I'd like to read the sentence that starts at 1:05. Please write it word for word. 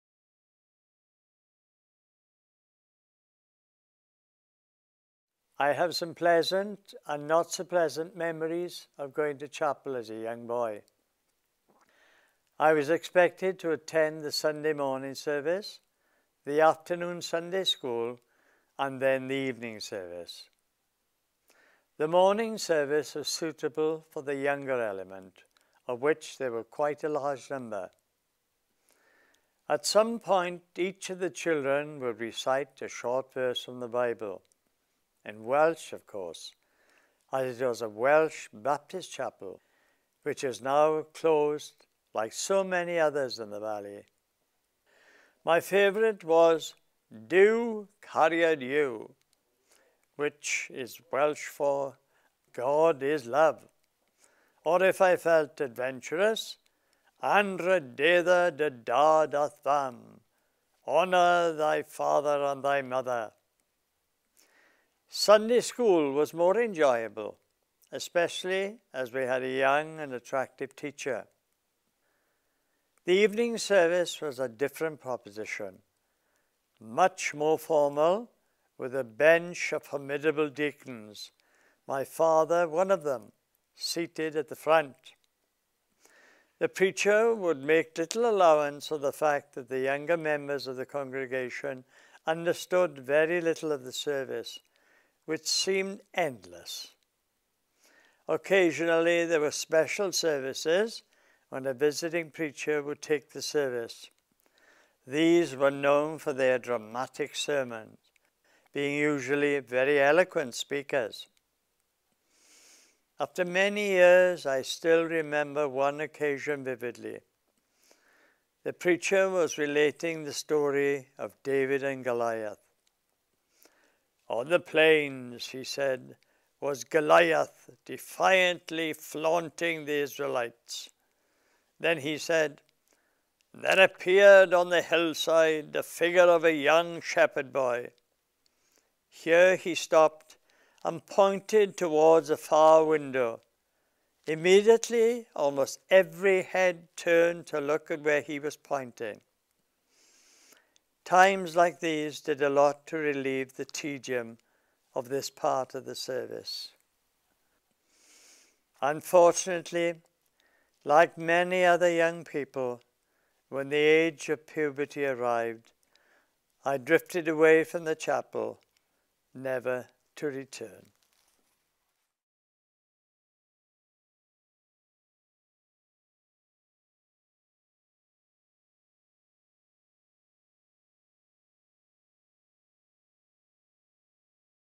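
Sunday school was more enjoyable, especially as we had a young and attractive teacher.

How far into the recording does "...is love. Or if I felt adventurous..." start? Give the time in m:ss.
0:53.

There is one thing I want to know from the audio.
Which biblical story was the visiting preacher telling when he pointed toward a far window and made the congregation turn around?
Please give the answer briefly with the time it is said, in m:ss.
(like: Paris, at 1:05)
David and Goliath, at 2:01.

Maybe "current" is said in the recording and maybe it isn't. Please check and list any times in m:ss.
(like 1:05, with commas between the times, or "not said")
not said.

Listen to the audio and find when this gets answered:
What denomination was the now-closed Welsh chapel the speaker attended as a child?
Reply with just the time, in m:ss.
0:38.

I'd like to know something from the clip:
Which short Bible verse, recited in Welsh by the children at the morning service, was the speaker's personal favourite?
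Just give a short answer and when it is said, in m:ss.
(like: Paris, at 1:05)
Duw cariad yw, at 0:47.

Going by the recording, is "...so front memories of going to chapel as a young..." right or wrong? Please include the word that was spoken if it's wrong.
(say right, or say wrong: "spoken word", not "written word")
wrong: "pleasant", not "front".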